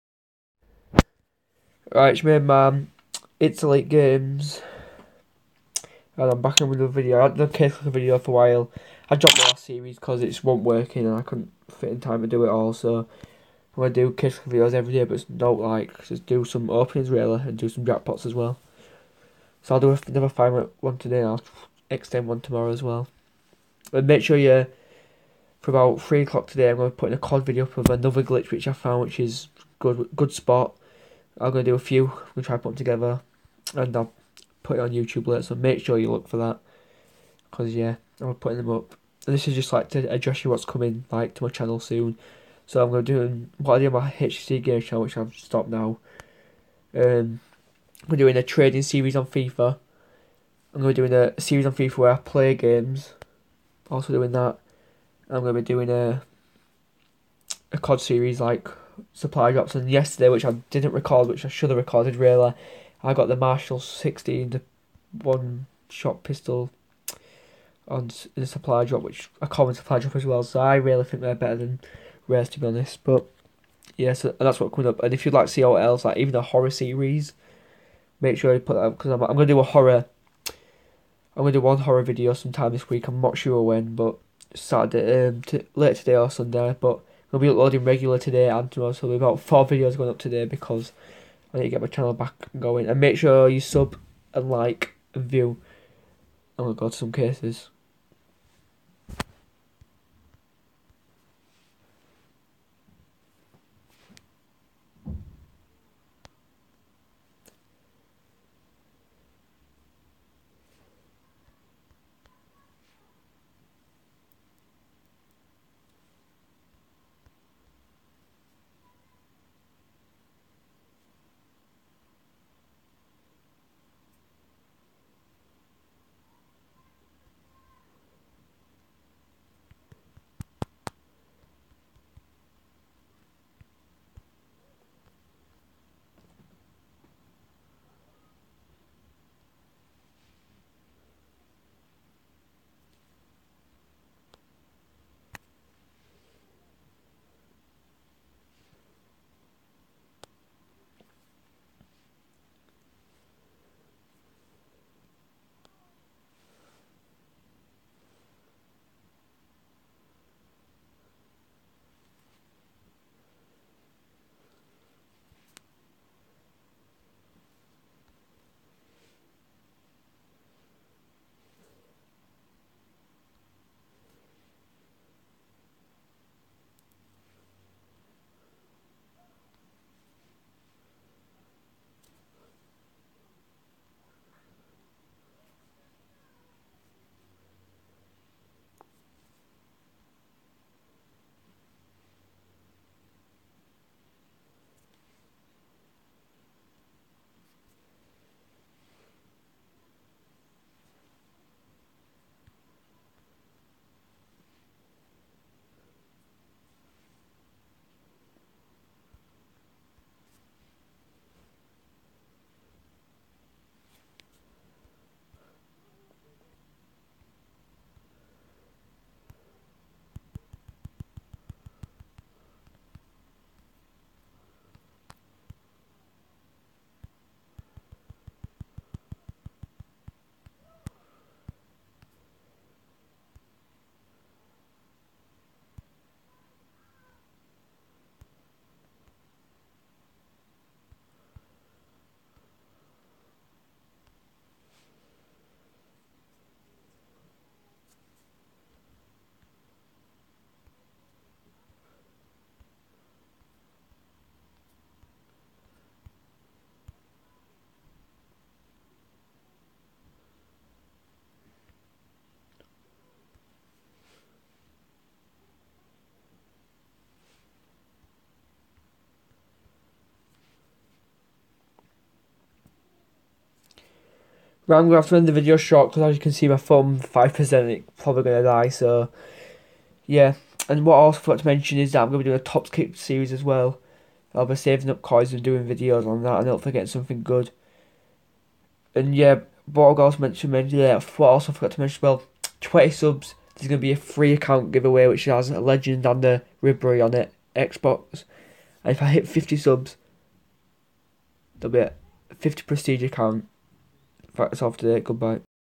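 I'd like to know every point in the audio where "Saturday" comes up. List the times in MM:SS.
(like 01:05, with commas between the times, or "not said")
01:24.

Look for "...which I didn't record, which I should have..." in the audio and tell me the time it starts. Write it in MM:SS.
01:00.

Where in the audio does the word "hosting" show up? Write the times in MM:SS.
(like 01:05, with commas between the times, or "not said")
not said.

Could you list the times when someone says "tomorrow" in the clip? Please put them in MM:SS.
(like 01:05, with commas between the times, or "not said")
00:22, 01:28.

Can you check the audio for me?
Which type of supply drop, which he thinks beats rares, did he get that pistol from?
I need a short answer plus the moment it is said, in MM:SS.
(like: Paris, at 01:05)
common, at 01:09.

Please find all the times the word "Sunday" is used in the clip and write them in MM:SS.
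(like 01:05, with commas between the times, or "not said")
01:26.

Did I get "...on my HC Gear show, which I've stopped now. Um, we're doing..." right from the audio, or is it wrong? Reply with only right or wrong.
right.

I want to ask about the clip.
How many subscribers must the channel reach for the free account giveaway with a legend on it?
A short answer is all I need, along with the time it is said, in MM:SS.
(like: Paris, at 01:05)
20, at 04:52.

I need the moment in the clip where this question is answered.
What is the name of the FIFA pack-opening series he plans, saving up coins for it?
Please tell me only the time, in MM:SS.
04:42.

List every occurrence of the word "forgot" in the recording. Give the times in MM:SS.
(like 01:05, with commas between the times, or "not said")
04:41, 04:51.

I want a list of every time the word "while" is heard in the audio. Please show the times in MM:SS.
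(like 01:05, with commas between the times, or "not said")
00:08.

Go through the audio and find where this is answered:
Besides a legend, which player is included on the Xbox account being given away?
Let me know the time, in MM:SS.
04:56.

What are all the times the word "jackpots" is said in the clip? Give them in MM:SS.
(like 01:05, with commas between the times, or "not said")
00:17.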